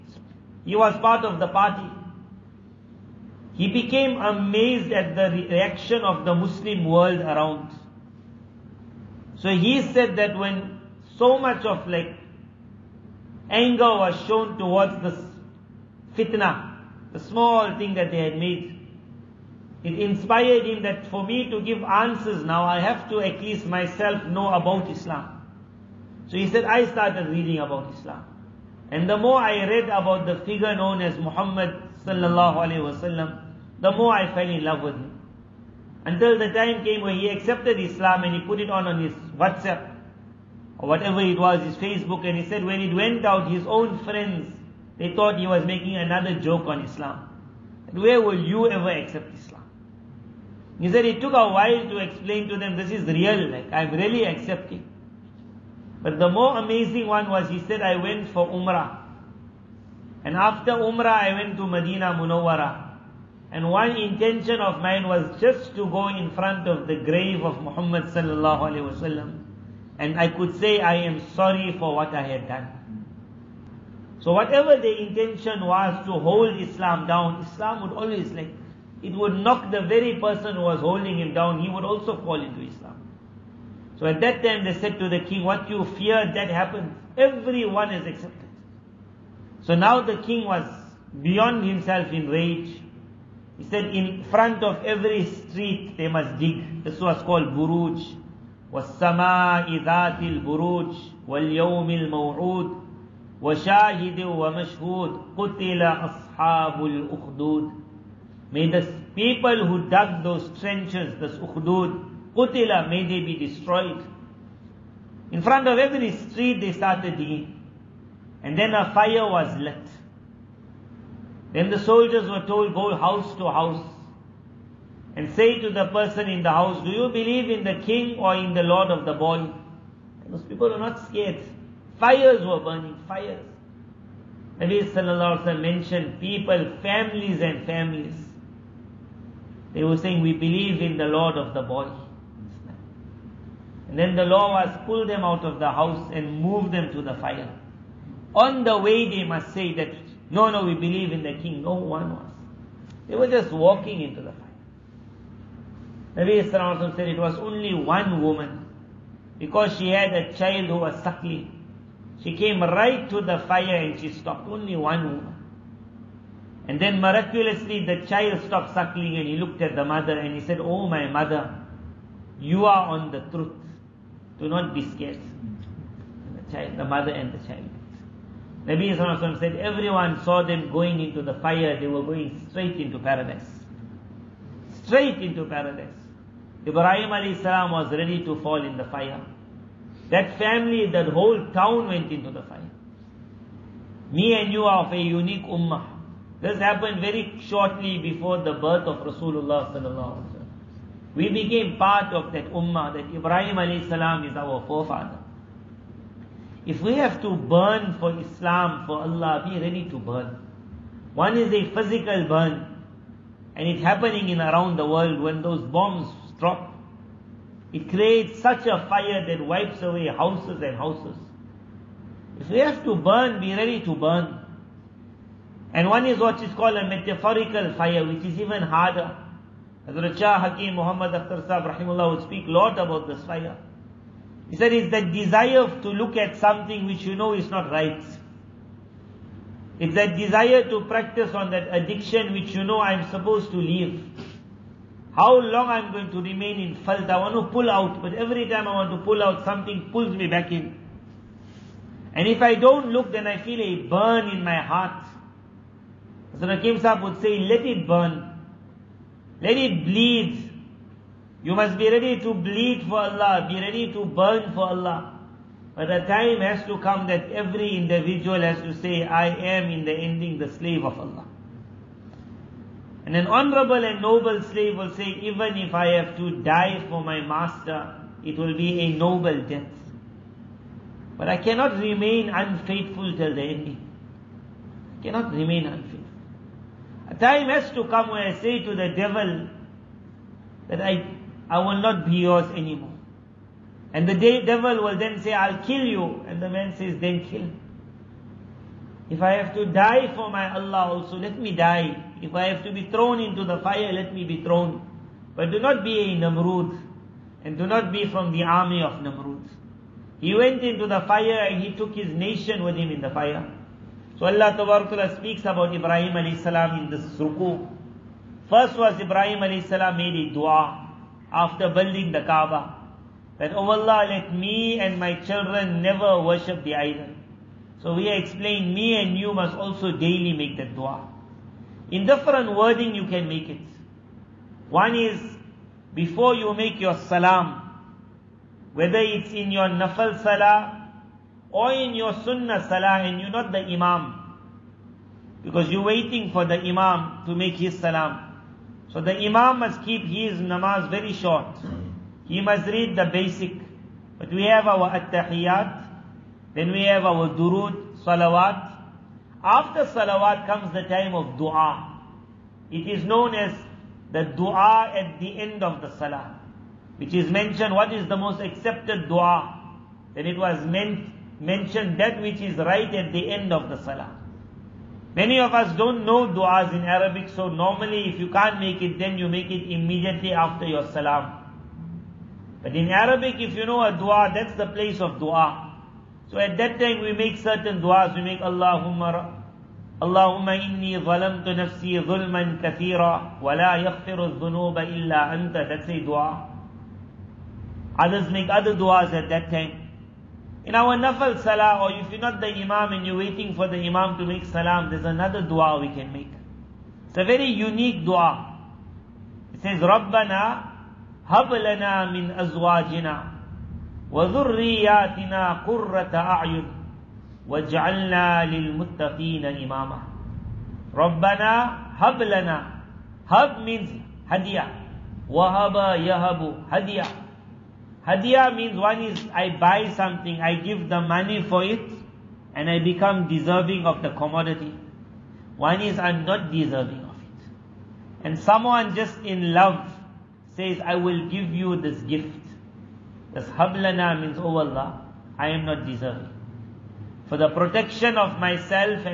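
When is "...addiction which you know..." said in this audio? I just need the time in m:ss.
4:01.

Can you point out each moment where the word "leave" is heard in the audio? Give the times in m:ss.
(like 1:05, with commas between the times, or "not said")
4:03.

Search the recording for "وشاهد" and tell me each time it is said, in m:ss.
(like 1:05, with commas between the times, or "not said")
1:43.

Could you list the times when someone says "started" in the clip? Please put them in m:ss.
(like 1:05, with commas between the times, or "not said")
0:26, 1:56.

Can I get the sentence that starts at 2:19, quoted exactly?
They were saying, we believe in the Lord of the body.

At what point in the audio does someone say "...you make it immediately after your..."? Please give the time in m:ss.
6:19.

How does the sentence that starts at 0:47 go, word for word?
Where will you ever accept Islam?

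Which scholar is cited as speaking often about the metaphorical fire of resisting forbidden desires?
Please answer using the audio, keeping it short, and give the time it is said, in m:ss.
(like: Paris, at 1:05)
Hakim Muhammad Akhtar, at 3:50.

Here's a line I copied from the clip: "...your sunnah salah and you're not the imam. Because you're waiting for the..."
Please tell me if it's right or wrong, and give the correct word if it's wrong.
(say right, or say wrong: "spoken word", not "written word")
right.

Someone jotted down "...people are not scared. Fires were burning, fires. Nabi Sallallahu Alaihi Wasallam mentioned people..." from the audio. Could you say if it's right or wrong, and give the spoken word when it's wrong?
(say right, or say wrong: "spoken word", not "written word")
right.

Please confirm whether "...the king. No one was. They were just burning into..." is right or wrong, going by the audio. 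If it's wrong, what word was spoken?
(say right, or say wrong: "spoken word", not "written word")
wrong: "walking", not "burning".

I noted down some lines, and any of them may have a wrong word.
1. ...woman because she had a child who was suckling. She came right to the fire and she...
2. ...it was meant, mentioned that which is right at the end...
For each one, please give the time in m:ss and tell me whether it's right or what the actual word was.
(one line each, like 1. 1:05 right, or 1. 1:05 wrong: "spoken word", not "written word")
1. 2:38 right
2. 6:10 right.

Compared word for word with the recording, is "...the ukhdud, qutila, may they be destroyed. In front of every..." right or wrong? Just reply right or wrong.
right.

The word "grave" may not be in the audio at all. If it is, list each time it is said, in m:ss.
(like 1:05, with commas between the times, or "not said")
1:06.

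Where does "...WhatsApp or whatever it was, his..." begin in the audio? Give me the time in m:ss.
0:39.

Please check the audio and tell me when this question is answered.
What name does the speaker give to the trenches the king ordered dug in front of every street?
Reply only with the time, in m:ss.
1:37.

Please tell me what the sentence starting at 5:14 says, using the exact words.
So Allah Ta'ala speaks about Ibrahim alayhi salam in this ruku.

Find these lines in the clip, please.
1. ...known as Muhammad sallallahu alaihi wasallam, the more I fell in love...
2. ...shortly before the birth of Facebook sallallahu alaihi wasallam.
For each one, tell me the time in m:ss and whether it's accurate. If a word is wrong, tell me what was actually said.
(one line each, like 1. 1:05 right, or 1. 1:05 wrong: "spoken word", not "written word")
1. 0:30 right
2. 3:17 wrong: "Rasulullah", not "Facebook".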